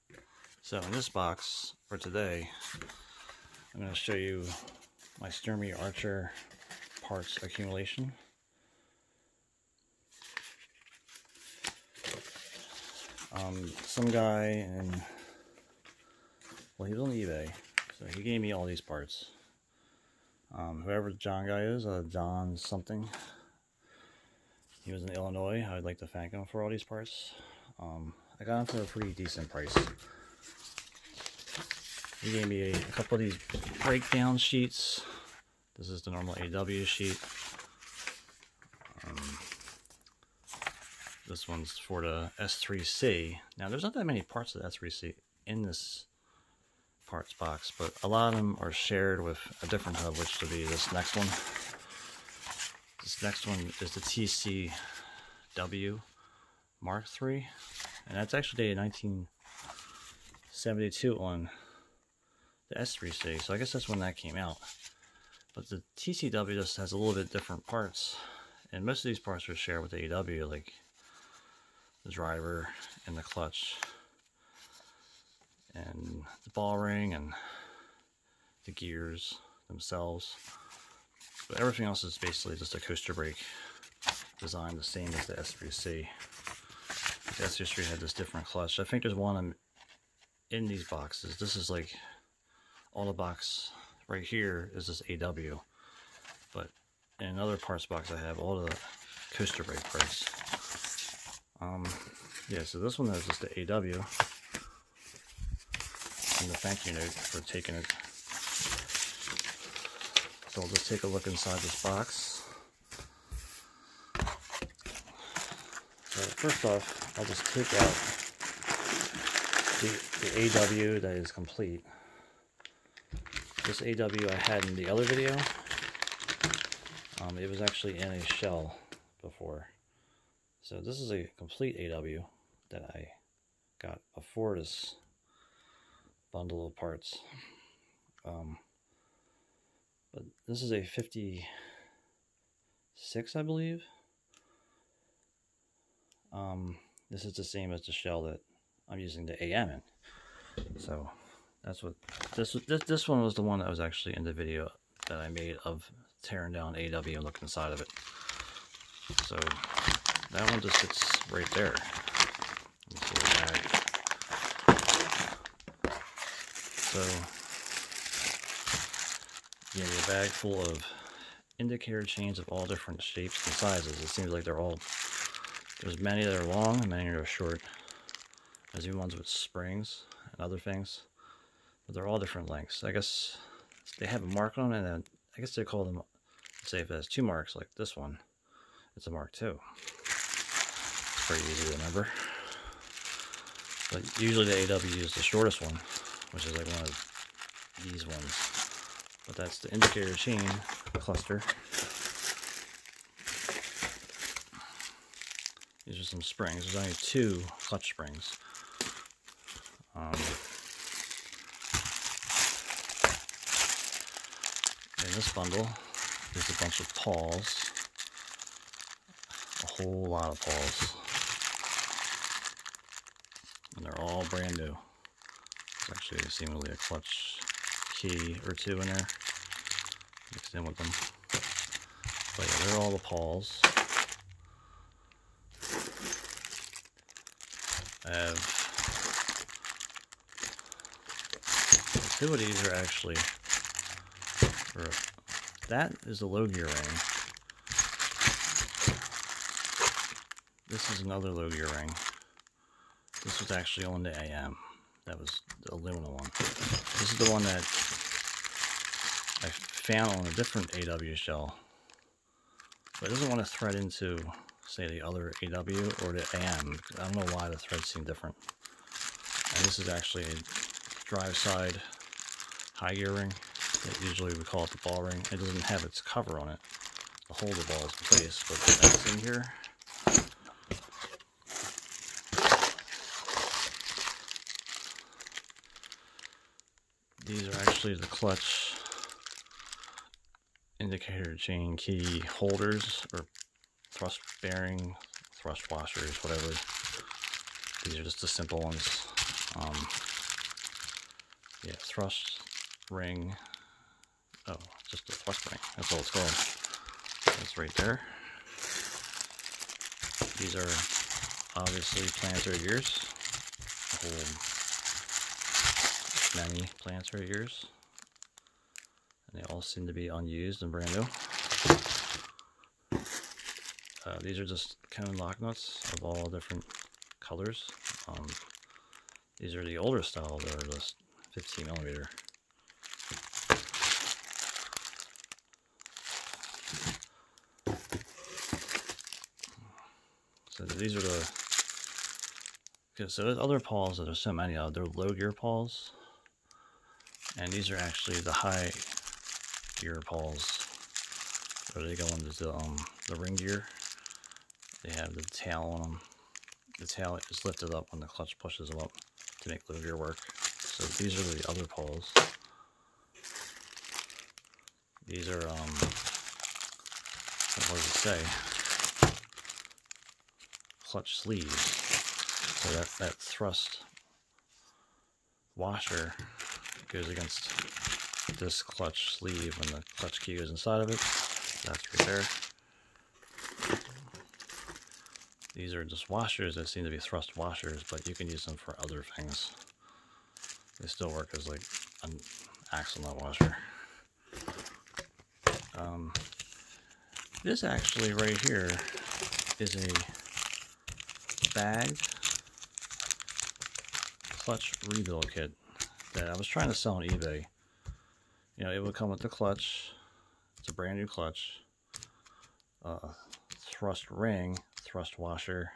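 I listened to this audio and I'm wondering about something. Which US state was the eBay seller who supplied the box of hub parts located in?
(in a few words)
Illinois.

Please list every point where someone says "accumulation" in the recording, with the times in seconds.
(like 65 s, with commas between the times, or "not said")
7 s.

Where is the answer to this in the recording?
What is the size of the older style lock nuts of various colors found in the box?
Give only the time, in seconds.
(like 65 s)
331 s.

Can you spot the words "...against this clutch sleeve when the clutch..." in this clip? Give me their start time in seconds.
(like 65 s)
377 s.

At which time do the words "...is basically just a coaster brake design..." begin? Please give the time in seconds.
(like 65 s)
82 s.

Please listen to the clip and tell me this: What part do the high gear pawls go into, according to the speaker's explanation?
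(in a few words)
ring gear.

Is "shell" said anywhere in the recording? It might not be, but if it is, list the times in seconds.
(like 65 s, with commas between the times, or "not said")
128 s, 147 s, 261 s.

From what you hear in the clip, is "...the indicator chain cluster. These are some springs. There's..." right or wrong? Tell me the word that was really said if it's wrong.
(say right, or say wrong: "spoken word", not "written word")
right.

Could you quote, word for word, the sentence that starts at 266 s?
I don't know why the threads seem different.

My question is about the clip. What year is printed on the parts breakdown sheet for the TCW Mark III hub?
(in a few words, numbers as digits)
1972.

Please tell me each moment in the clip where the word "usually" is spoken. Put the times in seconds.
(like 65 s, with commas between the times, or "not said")
194 s, 274 s.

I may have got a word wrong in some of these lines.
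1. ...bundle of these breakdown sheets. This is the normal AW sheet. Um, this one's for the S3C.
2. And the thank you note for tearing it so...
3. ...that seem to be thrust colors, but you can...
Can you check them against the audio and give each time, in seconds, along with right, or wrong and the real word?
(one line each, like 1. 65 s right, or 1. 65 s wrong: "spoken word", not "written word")
1. 32 s wrong: "couple", not "bundle"
2. 106 s wrong: "taking", not "tearing"
3. 386 s wrong: "washers", not "colors".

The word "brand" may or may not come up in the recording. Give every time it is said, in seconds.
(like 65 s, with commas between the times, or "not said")
224 s, 320 s, 410 s.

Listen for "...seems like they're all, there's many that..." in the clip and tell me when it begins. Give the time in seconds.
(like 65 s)
174 s.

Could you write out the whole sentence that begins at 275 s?
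It doesn't have its cover on it to hold the balls in place, but that's in here.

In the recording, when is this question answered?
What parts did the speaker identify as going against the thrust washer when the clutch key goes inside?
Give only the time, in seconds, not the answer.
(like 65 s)
370 s.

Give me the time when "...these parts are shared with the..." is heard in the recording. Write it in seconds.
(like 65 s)
69 s.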